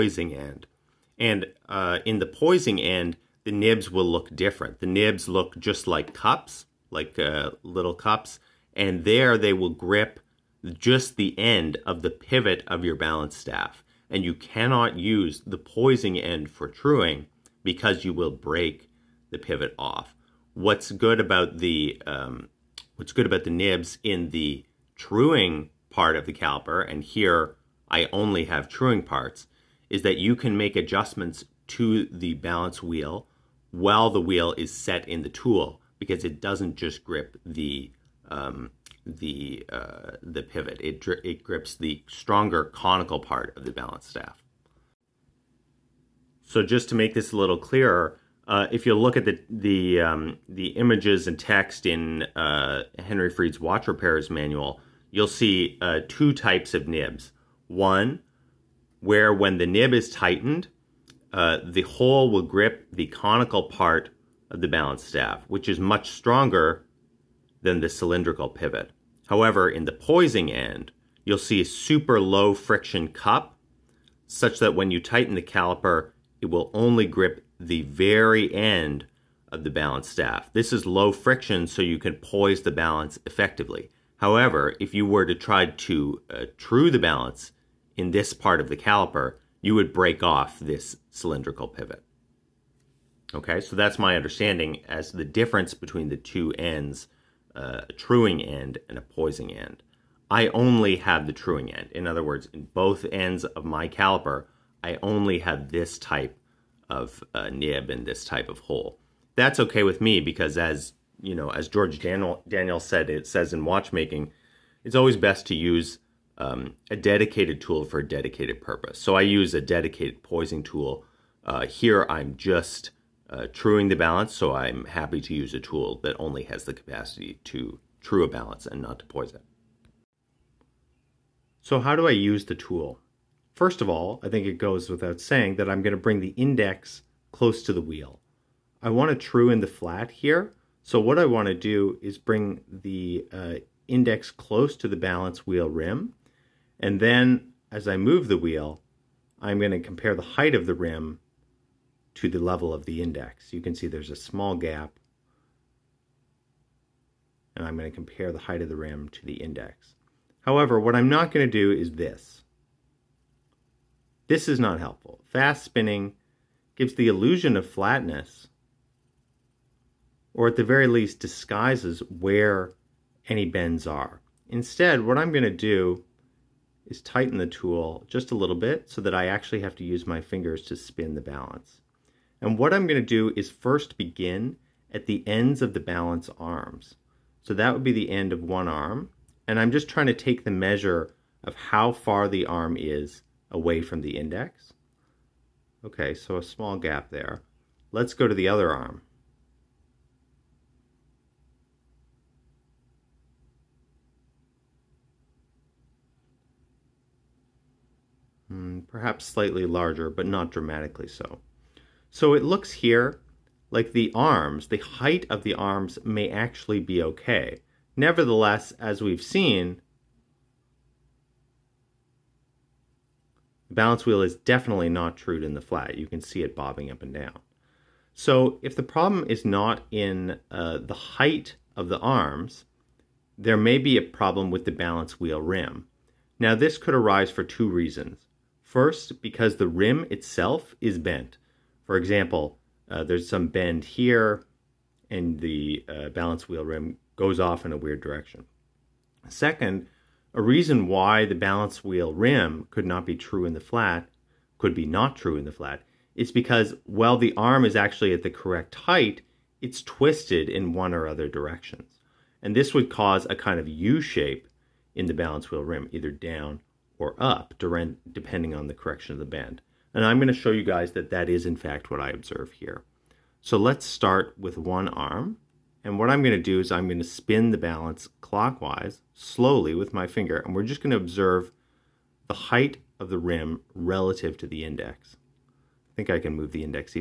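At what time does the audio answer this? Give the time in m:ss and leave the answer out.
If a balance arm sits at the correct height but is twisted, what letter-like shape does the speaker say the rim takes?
4:23.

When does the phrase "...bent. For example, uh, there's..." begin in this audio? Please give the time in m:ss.
4:00.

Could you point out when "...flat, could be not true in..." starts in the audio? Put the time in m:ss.
4:13.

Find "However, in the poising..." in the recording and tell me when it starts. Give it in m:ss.
1:09.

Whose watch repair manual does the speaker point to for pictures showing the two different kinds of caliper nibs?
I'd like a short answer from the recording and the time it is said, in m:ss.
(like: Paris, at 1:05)
Henry Fried, at 0:52.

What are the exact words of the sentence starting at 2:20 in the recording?
So what I want to do is bring the uh, index close to the balance wheel rim.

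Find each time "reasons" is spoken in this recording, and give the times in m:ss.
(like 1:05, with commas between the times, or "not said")
3:57, 4:10.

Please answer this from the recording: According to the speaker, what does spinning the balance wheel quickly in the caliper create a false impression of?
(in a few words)
flatness.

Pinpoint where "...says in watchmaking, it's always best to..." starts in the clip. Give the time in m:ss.
1:53.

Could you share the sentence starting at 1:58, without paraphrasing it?
So I use a dedicated poising tool.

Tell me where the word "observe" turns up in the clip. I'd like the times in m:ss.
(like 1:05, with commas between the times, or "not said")
4:32, 4:40.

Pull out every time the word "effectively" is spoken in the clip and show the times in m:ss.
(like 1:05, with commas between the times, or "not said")
1:23.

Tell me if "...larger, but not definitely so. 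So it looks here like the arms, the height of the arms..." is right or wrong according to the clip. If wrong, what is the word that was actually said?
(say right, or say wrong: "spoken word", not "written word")
wrong: "dramatically", not "definitely".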